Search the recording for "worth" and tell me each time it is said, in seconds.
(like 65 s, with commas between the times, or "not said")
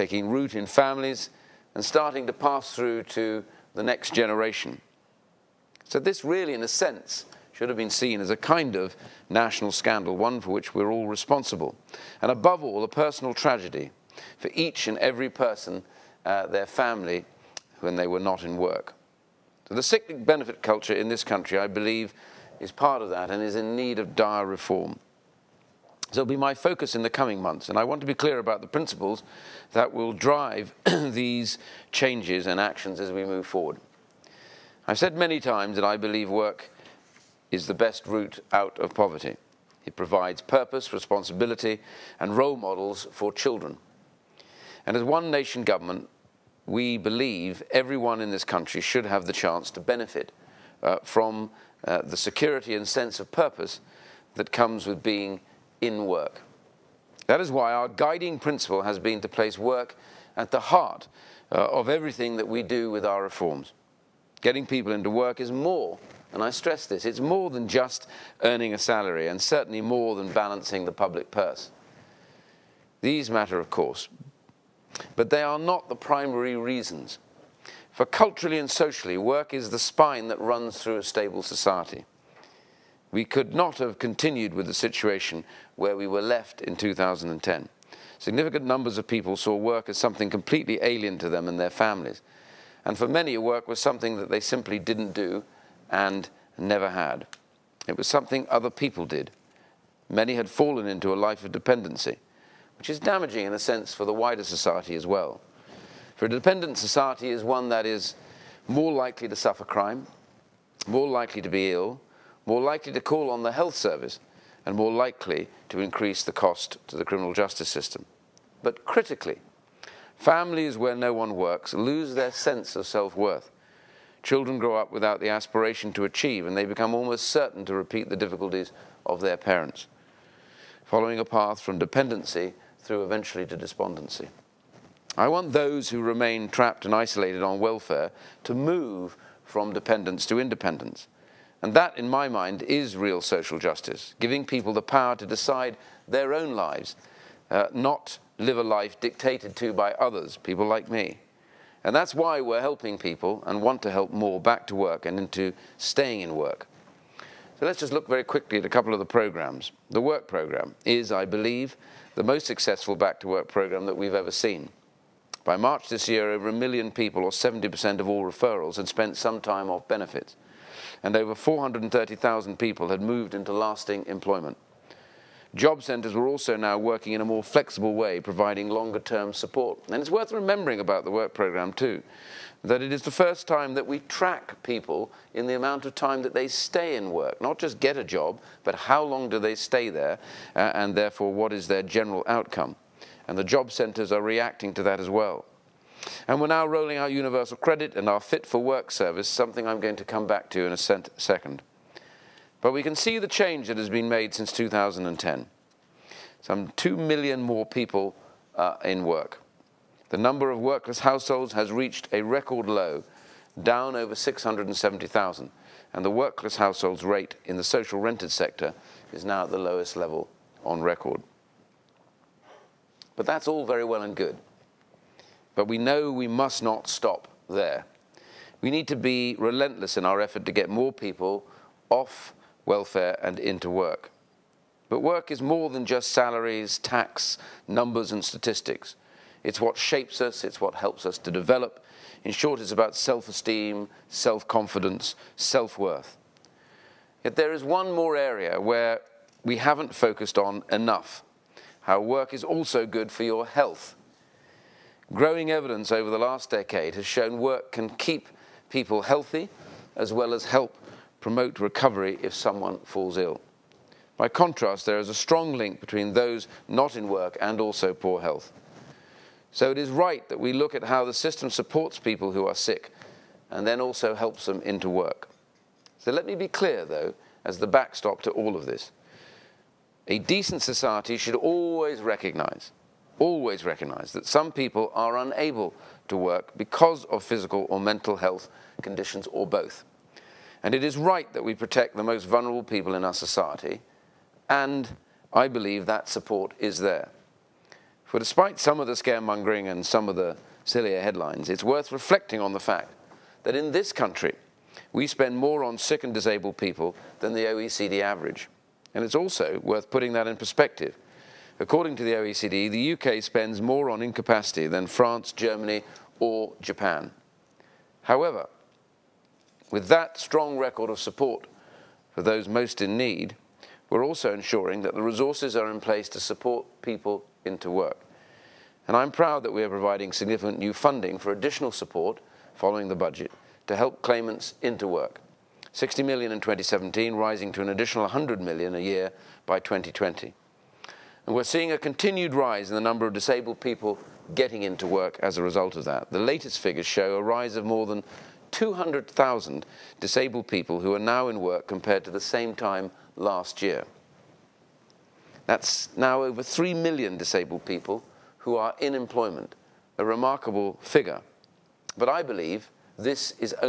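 123 s, 180 s, 245 s, 301 s, 309 s.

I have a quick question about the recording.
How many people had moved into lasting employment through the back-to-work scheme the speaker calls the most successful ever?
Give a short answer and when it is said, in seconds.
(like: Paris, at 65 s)
430,000, at 171 s.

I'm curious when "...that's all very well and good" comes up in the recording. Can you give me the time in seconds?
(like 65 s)
223 s.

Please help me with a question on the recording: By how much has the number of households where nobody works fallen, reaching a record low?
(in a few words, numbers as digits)
670,000.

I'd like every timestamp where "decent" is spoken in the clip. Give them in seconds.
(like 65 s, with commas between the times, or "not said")
280 s.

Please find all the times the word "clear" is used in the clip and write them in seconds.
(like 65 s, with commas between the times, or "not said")
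28 s, 276 s.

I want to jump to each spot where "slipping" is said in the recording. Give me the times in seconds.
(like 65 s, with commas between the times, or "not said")
not said.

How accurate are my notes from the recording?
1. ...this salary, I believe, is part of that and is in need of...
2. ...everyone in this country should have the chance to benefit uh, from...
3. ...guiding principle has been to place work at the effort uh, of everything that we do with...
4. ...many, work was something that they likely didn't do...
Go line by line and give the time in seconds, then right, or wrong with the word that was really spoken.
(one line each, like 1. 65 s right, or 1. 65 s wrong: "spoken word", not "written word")
1. 21 s wrong: "country", not "salary"
2. 47 s right
3. 57 s wrong: "heart", not "effort"
4. 93 s wrong: "simply", not "likely".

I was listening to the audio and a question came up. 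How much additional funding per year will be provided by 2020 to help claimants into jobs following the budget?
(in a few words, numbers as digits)
100 million.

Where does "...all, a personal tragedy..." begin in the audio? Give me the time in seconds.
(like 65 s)
12 s.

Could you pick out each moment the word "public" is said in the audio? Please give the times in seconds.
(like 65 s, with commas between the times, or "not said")
70 s.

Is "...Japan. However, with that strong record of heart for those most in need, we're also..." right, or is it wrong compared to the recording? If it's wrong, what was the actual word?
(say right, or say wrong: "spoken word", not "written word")
wrong: "support", not "heart".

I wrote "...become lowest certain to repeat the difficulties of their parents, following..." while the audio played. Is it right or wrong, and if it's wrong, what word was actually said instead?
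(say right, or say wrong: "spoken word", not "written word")
wrong: "almost", not "lowest".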